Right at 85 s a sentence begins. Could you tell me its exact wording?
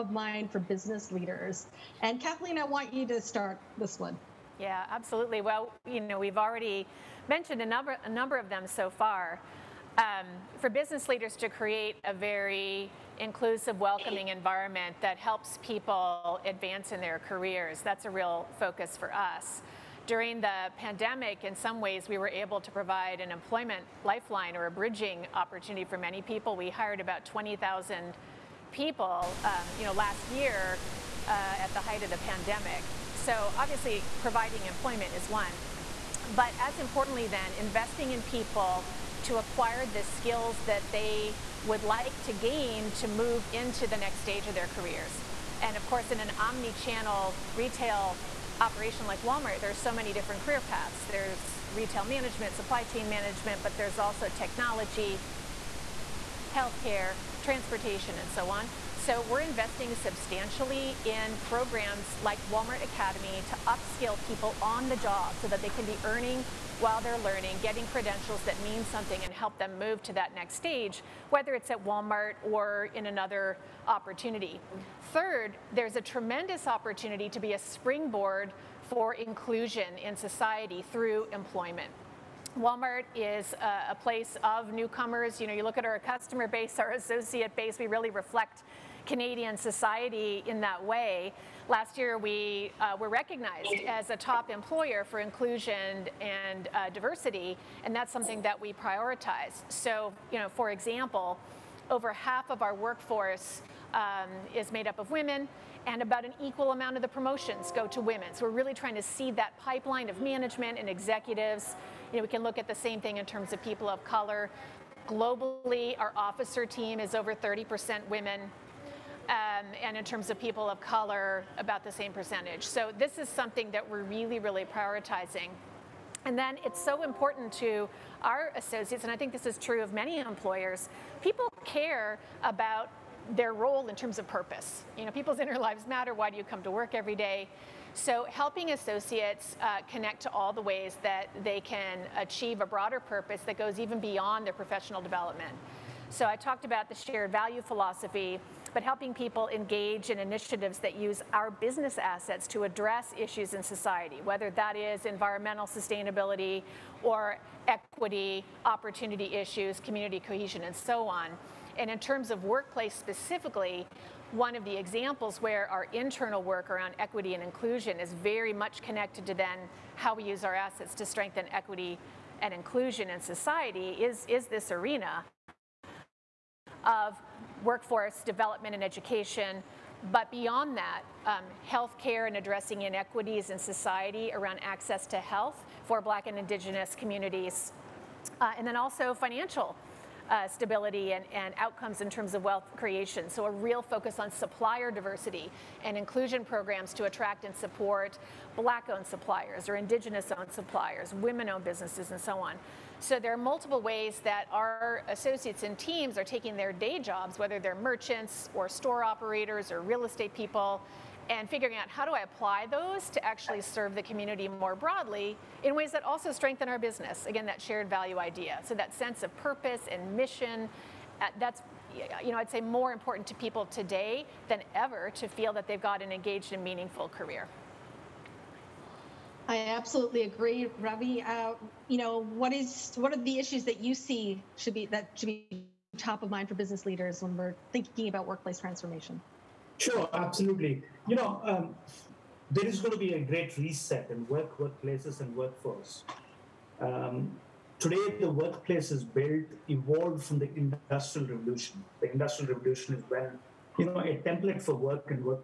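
You know, you look at our customer base, our associate base, we really reflect Canadian society in that way.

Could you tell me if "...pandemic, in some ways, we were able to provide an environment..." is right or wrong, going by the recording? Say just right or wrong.
wrong.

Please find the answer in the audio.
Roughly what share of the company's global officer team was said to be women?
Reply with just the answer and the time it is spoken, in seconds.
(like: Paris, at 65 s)
over 30%, at 117 s.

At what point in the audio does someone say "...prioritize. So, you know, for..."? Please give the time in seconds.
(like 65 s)
98 s.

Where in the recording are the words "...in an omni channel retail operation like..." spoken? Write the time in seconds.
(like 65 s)
46 s.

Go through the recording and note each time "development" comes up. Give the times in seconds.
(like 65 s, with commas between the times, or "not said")
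145 s, 178 s.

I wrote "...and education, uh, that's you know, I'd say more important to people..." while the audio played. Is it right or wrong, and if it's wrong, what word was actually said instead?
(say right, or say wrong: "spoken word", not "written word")
wrong: "mission", not "education".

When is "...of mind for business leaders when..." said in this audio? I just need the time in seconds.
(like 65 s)
236 s.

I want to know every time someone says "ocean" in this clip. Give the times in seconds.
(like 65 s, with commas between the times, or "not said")
not said.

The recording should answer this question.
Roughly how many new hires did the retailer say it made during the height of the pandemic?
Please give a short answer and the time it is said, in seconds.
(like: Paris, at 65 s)
20,000, at 27 s.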